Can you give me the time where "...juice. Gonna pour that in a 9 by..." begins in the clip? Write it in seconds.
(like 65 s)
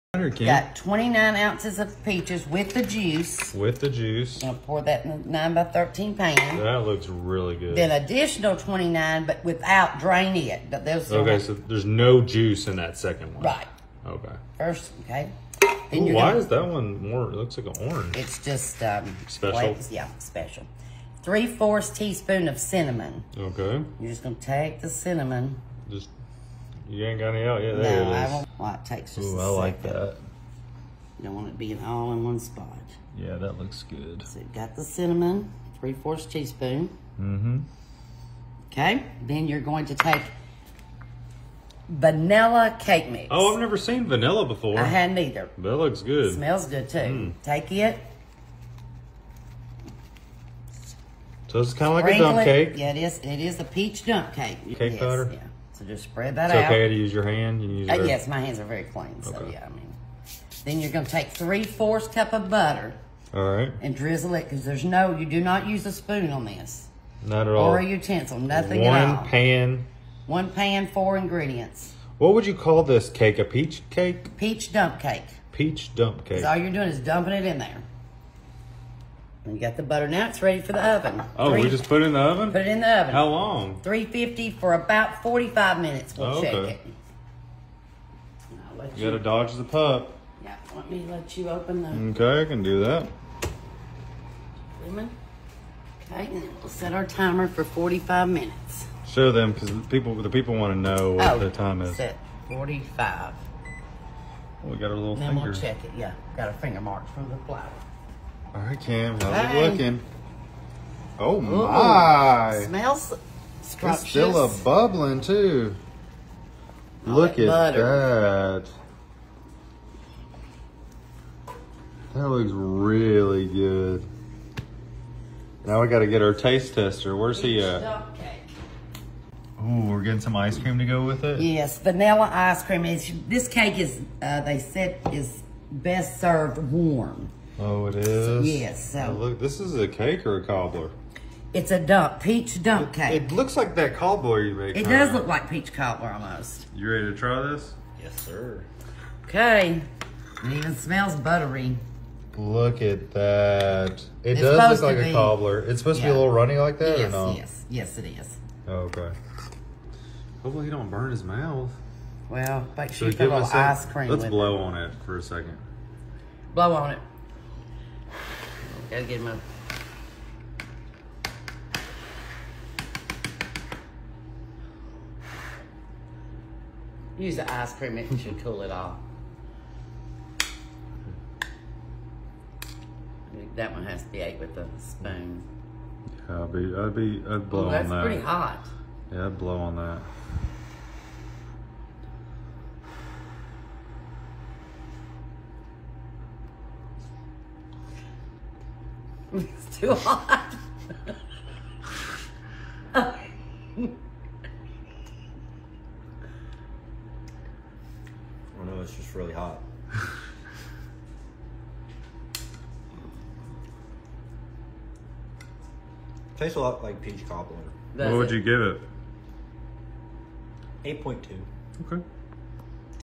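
3 s.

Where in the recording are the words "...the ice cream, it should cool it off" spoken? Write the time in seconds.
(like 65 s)
177 s.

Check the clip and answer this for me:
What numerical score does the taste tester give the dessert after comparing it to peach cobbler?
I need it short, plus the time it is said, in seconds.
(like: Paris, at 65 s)
8.2, at 221 s.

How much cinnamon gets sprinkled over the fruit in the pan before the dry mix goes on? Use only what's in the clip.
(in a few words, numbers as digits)
3/4 teaspoon.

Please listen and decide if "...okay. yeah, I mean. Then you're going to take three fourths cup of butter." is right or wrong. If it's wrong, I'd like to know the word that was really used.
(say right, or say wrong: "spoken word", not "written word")
right.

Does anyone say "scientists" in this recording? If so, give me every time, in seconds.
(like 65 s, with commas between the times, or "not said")
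not said.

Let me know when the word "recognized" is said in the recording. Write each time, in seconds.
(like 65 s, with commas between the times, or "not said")
not said.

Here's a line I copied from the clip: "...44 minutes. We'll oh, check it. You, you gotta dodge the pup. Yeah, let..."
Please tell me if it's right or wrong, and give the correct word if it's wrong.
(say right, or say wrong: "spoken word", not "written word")
wrong: "45", not "44".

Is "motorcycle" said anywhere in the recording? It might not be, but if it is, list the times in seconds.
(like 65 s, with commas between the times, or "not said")
not said.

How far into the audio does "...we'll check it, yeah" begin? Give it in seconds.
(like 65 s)
105 s.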